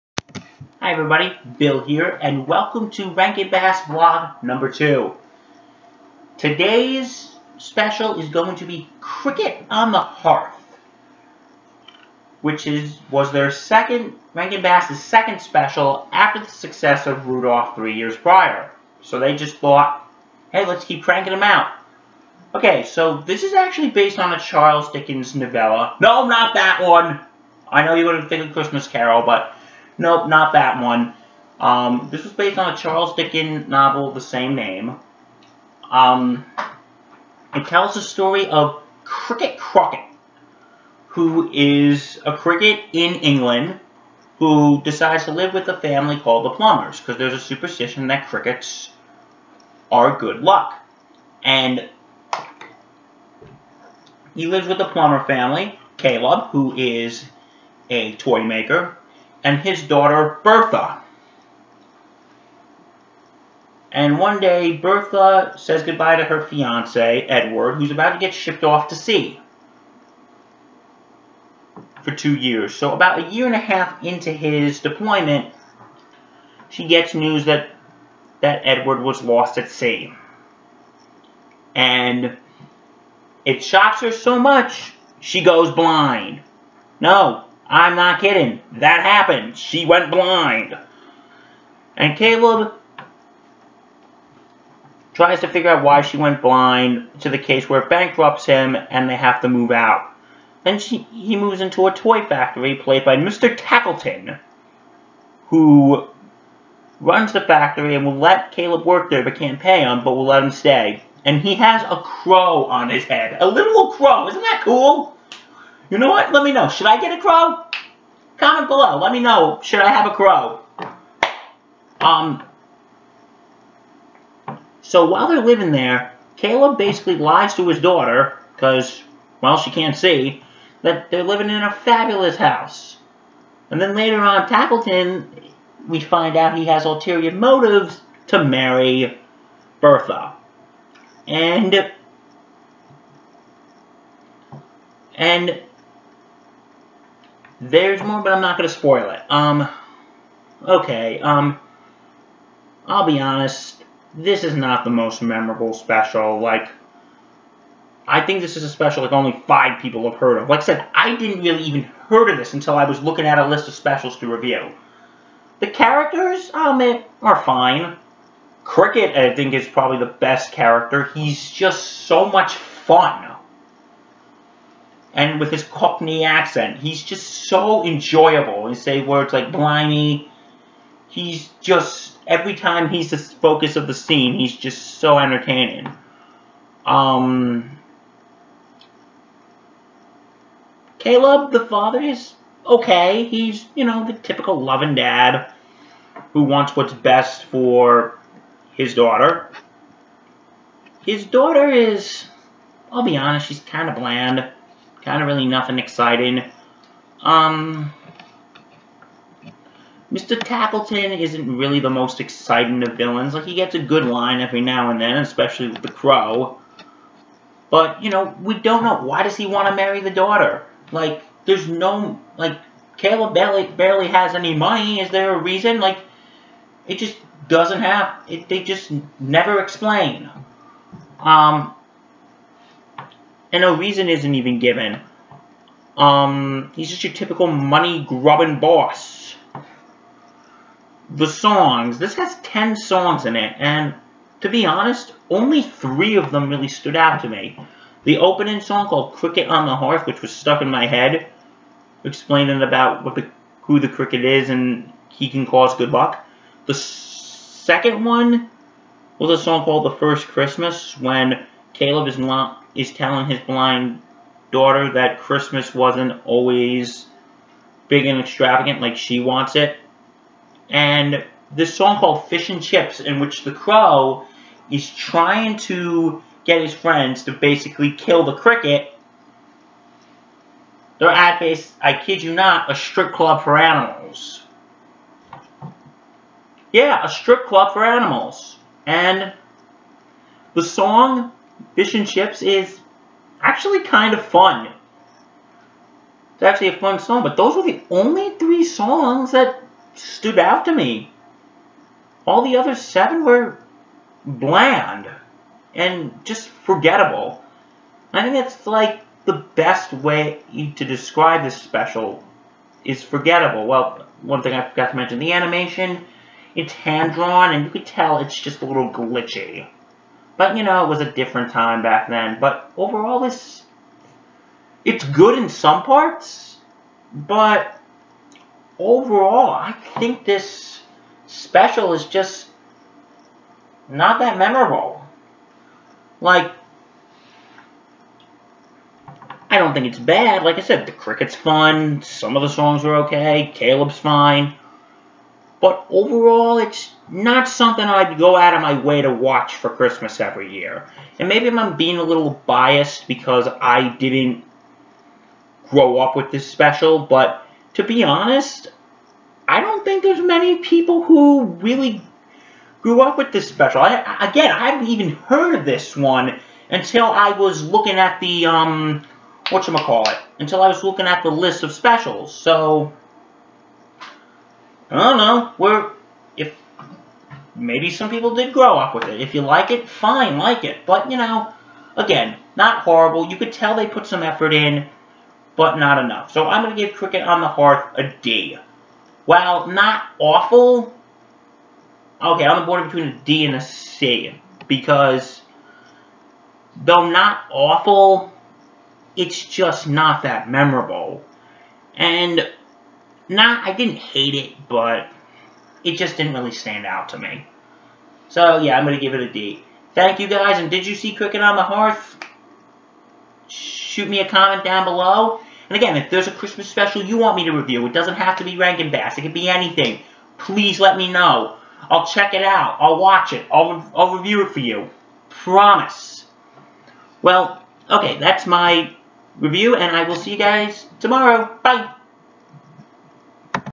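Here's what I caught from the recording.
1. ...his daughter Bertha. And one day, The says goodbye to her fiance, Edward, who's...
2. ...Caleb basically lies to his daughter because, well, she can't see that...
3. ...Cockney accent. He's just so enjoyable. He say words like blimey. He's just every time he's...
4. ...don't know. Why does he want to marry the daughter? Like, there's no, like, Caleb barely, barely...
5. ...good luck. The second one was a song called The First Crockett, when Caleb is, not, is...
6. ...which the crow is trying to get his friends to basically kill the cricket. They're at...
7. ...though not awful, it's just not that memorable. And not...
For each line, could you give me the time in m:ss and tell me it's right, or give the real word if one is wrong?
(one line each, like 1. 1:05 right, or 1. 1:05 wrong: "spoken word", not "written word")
1. 0:59 wrong: "Bertha", not "The"
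2. 2:06 right
3. 2:55 right
4. 3:38 right
5. 4:15 wrong: "Christmas", not "Crockett"
6. 4:33 right
7. 6:36 right.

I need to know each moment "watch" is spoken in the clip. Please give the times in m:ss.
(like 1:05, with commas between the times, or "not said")
5:49, 7:02.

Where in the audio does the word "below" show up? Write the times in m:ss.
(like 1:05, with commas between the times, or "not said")
1:58, 6:54.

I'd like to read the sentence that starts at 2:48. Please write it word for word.
Cricket, I think, is probably the best character.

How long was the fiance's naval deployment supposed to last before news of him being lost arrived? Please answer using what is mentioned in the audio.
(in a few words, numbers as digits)
2 years.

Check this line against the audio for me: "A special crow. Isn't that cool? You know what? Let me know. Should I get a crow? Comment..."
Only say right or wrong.
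wrong.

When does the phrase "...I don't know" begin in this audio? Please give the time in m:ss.
6:14.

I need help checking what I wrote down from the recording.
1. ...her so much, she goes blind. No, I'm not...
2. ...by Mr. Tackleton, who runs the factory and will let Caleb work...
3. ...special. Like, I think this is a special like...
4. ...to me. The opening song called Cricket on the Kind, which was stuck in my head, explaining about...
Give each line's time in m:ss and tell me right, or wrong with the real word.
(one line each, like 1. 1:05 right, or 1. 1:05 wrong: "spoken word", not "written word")
1. 1:24 right
2. 1:43 right
3. 2:35 right
4. 4:07 wrong: "Hearth", not "Kind".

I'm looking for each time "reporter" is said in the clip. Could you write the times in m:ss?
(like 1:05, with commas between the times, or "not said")
not said.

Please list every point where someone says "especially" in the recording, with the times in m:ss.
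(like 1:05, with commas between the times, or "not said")
3:35.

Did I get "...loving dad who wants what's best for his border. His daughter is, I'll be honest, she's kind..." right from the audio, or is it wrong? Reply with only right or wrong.
wrong.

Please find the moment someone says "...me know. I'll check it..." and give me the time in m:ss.
7:00.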